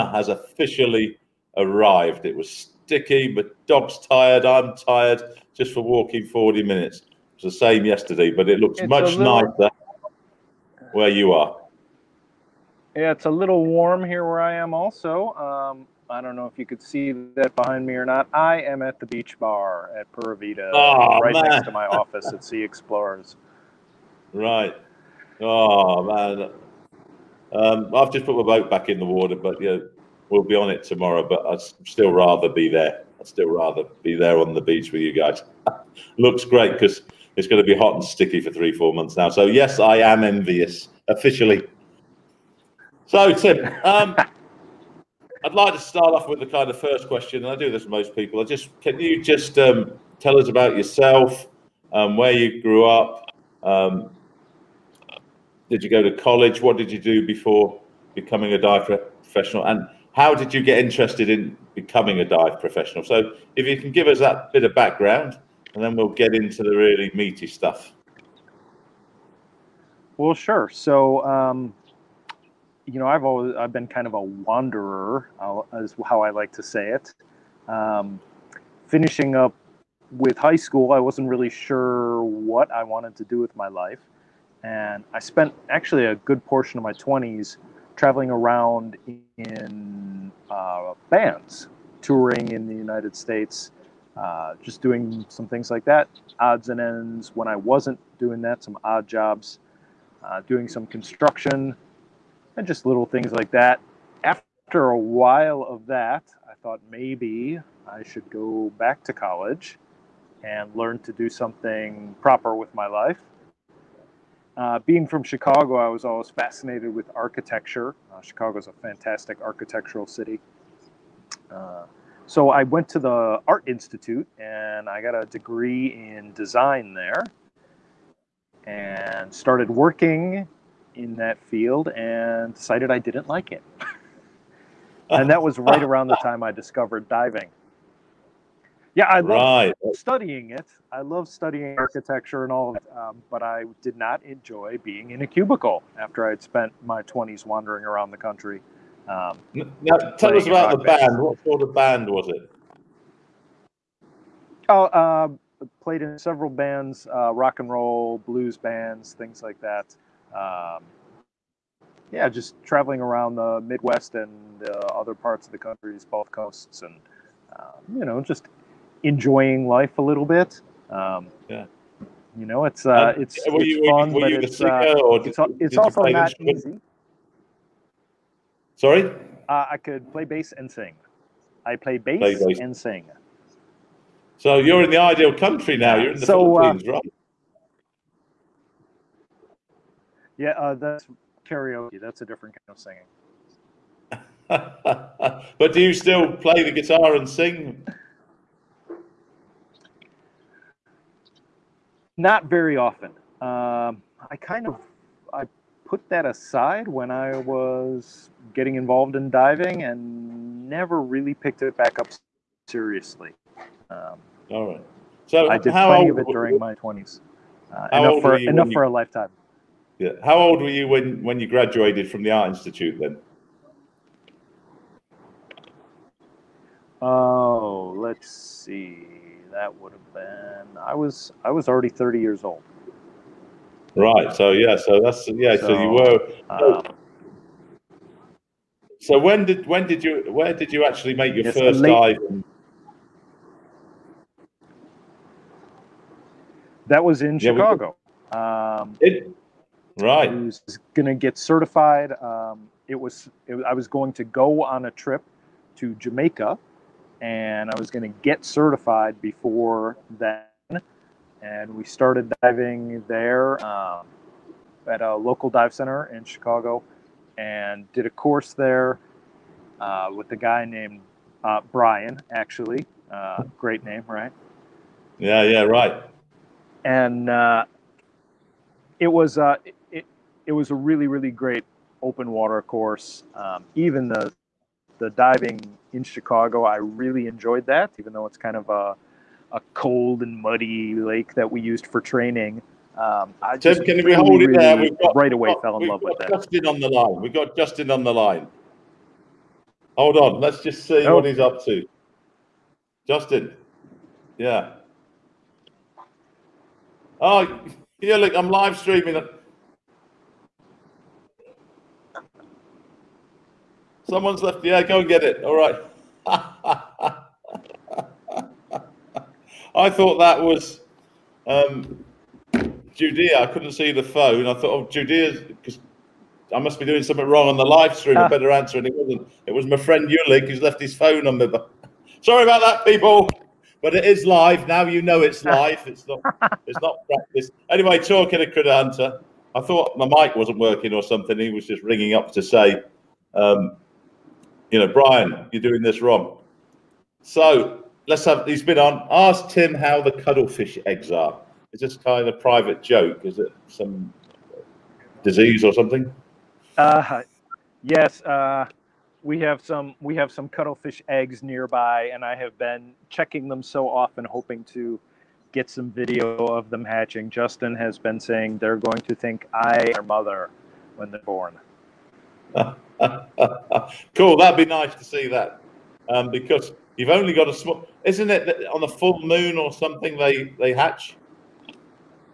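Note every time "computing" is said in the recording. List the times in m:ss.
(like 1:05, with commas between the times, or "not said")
not said.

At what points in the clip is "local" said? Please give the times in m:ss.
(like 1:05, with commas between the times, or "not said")
4:25.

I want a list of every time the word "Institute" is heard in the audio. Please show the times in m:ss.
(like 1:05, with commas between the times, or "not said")
2:03, 3:42.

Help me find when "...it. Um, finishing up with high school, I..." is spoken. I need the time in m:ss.
1:16.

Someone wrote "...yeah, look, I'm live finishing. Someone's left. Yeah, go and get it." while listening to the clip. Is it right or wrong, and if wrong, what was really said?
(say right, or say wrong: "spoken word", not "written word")
wrong: "streaming", not "finishing".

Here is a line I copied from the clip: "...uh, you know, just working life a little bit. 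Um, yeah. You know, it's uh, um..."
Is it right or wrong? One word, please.
wrong.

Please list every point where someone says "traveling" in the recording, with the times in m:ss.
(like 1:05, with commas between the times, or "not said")
1:27, 2:42.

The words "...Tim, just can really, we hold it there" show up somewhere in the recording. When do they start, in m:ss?
4:53.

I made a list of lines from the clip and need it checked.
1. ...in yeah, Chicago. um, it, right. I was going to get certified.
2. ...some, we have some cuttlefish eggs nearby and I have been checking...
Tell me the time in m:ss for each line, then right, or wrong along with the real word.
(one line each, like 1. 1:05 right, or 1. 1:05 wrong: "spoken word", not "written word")
1. 4:07 right
2. 5:59 right.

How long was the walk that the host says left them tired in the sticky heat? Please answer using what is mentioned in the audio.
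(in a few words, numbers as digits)
40 minutes.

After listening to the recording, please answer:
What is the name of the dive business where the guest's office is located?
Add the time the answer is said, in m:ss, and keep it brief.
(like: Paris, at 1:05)
Sea Explorers, at 0:22.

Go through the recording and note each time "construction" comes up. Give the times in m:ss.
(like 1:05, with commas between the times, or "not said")
1:40.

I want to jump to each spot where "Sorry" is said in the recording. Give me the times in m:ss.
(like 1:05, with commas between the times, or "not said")
2:58, 5:32.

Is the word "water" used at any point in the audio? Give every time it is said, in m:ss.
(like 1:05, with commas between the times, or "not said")
0:29, 4:42.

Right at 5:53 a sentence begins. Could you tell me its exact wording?
Is it some disease or something?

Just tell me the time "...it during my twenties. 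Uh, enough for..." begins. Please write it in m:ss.
3:36.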